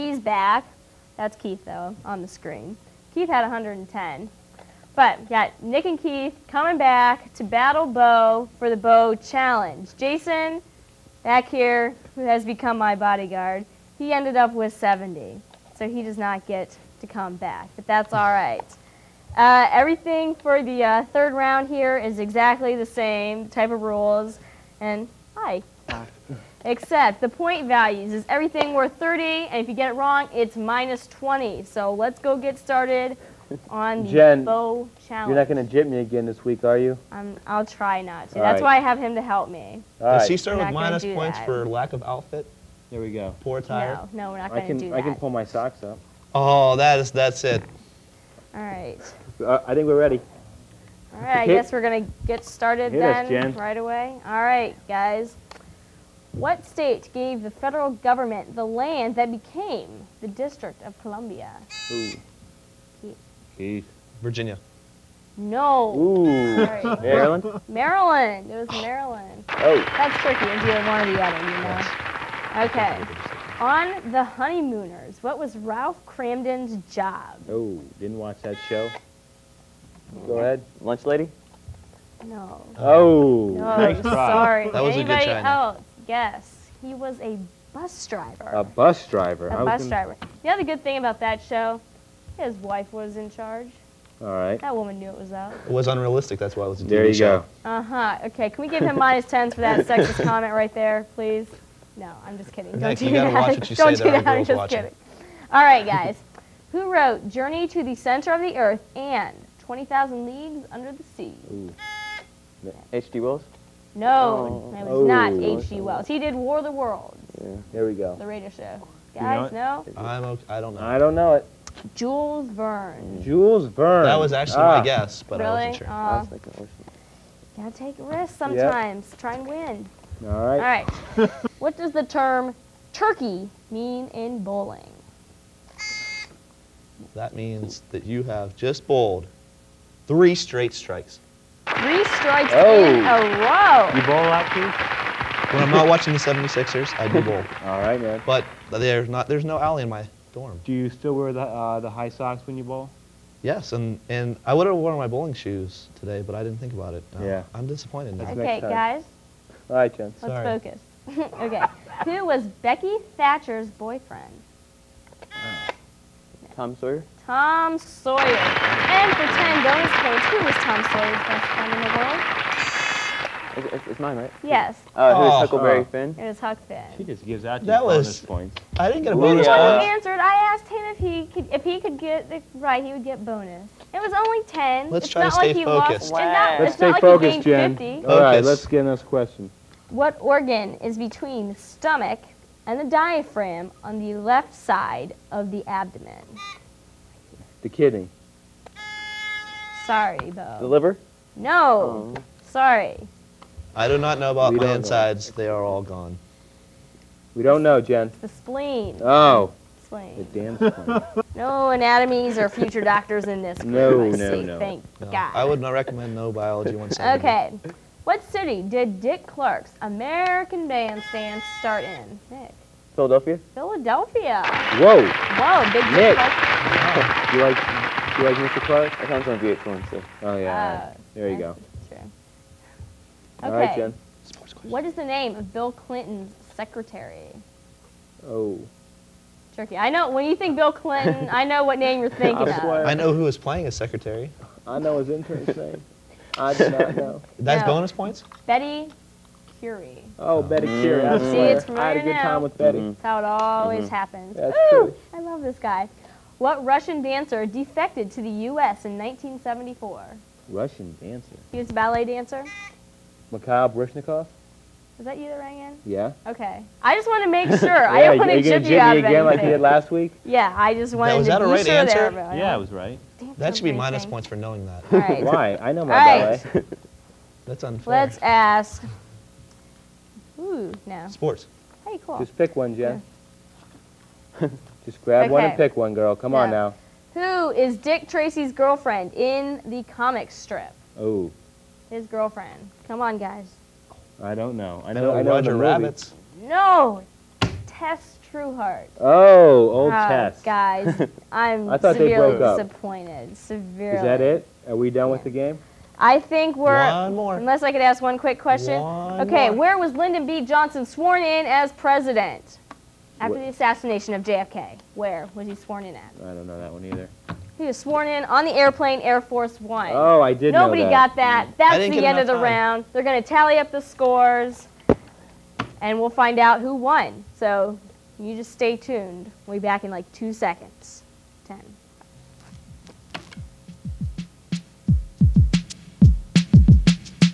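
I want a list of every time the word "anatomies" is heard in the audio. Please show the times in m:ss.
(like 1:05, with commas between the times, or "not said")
3:31.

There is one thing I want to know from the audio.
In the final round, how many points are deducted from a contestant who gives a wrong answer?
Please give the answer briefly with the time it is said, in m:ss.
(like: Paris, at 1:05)
20, at 0:30.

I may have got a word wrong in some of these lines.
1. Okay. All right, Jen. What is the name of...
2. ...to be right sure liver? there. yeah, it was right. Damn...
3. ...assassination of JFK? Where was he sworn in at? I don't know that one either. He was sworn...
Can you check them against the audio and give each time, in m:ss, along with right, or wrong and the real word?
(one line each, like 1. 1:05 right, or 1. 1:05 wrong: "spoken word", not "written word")
1. 3:51 right
2. 4:31 wrong: "answer", not "liver"
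3. 5:13 right.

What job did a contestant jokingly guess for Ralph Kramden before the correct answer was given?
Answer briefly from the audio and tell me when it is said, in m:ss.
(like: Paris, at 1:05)
Lunch lady, at 1:20.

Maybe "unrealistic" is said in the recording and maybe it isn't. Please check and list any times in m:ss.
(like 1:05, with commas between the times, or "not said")
1:35.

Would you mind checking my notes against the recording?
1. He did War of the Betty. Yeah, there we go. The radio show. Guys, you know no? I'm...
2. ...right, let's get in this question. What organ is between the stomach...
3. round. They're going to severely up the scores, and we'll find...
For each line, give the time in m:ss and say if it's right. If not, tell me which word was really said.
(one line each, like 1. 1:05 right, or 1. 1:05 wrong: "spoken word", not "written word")
1. 1:56 wrong: "Worlds", not "Betty"
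2. 3:08 right
3. 5:22 wrong: "tally", not "severely".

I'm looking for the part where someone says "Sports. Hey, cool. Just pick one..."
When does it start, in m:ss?
4:41.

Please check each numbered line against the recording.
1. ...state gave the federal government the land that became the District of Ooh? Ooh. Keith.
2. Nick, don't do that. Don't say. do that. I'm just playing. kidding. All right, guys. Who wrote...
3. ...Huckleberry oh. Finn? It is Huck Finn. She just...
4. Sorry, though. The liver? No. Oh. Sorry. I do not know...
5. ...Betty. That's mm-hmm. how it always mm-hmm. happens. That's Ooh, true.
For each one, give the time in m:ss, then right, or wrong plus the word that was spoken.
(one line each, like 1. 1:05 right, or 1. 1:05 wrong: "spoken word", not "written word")
1. 0:56 wrong: "Columbia", not "Ooh"
2. 1:42 wrong: "watching", not "playing"
3. 2:55 right
4. 3:19 right
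5. 4:12 right.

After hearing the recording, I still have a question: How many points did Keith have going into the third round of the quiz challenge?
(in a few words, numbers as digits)
110.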